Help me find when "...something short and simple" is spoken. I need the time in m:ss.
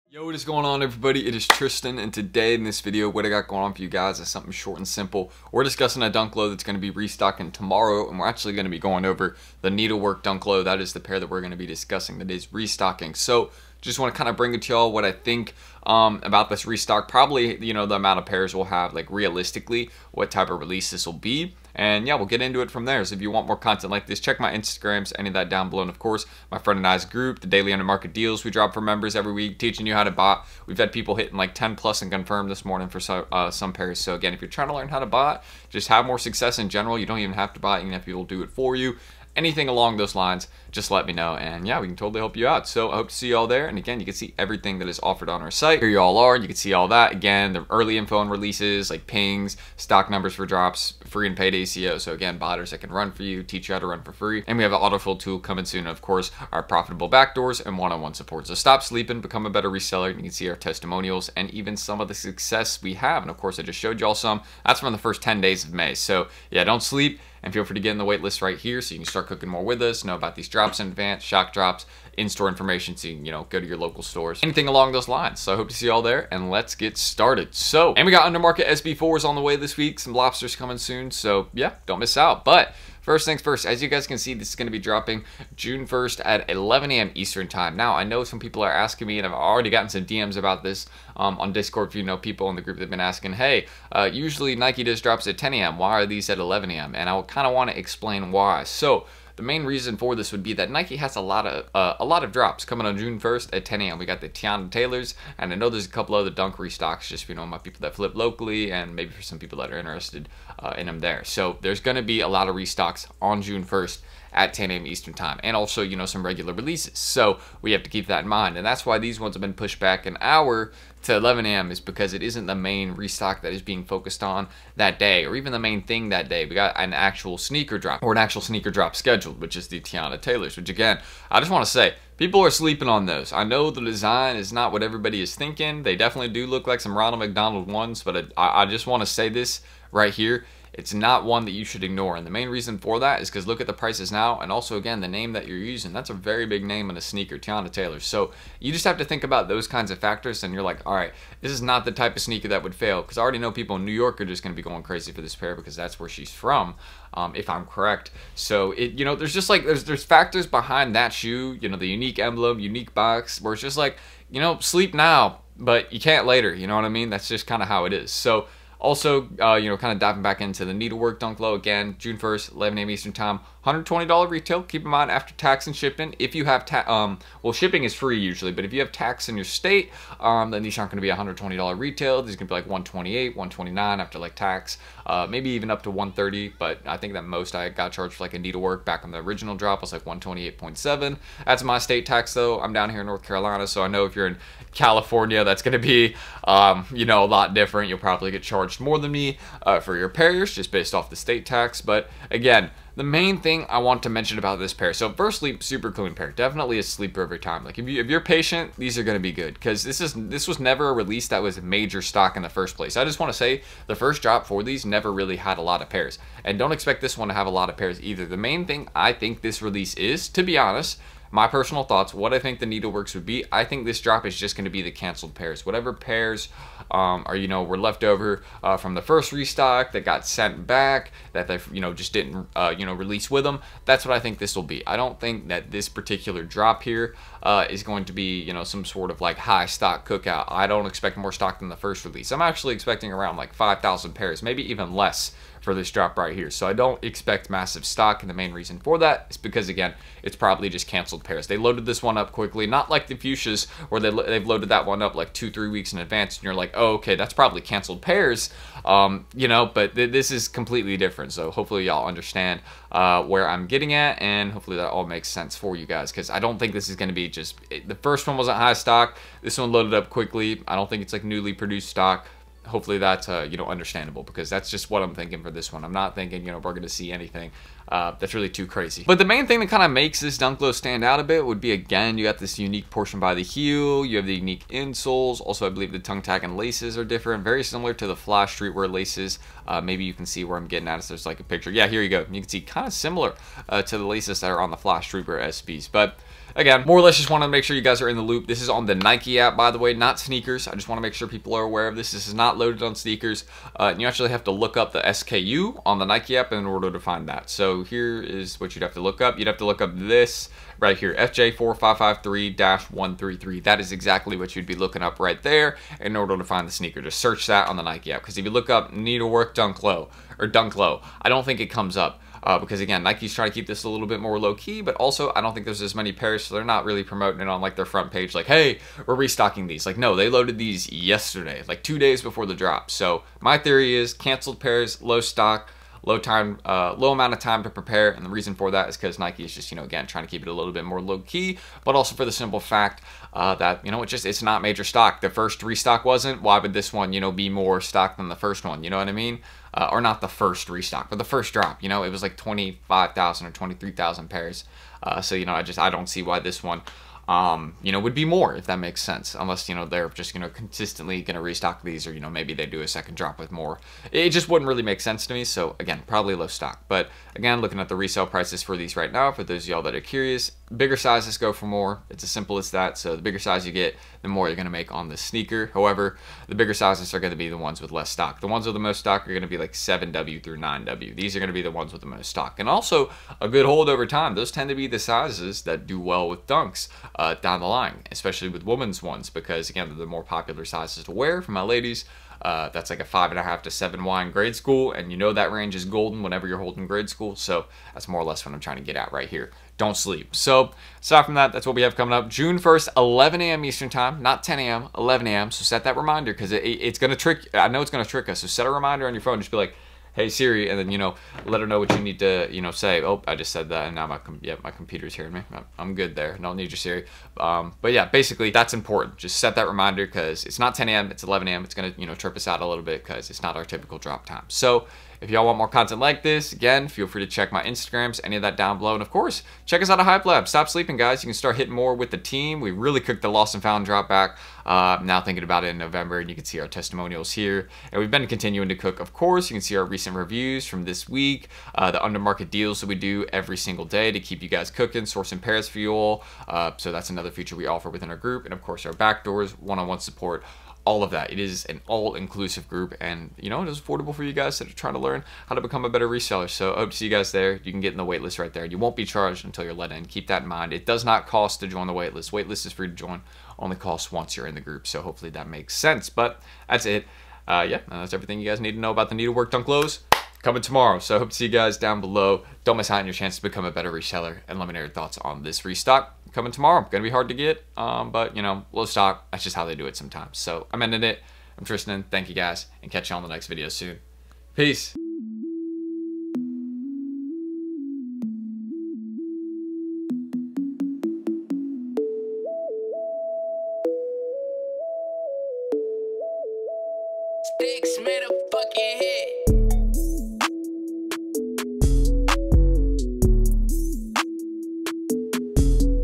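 0:04.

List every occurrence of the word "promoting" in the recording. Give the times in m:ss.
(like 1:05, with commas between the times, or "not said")
5:27.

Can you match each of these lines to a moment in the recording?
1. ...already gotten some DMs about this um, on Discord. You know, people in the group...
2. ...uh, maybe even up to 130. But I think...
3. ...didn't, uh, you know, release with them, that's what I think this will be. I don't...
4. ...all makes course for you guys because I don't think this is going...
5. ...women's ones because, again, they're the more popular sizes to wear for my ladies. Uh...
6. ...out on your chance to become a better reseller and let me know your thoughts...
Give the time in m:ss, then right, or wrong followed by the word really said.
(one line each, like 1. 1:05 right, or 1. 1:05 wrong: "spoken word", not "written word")
1. 1:29 right
2. 3:05 right
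3. 3:52 right
4. 4:24 wrong: "sense", not "course"
5. 6:28 right
6. 7:52 right.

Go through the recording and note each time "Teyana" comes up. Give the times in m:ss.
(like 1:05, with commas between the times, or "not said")
1:44, 2:09, 2:27.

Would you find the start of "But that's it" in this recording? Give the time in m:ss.
7:46.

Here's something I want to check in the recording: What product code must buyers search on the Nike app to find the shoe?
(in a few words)
FJ4553-133.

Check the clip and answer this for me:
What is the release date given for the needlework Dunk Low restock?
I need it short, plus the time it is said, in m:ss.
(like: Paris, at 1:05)
June 1st, at 1:25.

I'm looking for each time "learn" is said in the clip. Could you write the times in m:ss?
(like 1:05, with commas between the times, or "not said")
0:34, 7:34.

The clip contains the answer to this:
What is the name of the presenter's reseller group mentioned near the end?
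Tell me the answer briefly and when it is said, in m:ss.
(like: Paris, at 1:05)
Hype Lab, at 7:10.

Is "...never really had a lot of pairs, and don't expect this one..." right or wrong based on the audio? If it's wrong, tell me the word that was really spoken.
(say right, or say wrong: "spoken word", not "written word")
right.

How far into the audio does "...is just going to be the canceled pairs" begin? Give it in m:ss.
3:44.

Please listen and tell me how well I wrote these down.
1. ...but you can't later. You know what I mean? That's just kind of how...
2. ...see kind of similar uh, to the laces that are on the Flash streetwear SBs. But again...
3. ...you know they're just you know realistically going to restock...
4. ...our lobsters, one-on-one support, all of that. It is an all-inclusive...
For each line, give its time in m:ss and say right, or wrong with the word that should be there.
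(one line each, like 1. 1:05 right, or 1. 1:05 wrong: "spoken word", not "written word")
1. 2:45 right
2. 4:52 right
3. 5:59 wrong: "consistently", not "realistically"
4. 7:28 wrong: "backdoors", not "lobsters".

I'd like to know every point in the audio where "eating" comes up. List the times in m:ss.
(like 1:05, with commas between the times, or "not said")
not said.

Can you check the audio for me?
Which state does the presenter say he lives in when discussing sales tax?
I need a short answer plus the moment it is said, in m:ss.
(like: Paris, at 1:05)
North Carolina, at 3:13.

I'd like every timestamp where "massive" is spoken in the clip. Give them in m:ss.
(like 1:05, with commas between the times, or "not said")
4:07.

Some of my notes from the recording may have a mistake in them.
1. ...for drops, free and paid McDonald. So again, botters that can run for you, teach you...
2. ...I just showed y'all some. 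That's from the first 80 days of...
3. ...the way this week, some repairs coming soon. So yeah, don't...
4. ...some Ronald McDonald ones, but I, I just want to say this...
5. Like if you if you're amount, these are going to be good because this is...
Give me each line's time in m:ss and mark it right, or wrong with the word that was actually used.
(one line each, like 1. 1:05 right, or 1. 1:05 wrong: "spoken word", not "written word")
1. 0:50 wrong: "ACO", not "McDonald"
2. 1:03 wrong: "10", not "80"
3. 1:19 wrong: "lobsters", not "repairs"
4. 2:16 right
5. 3:27 wrong: "patient", not "amount".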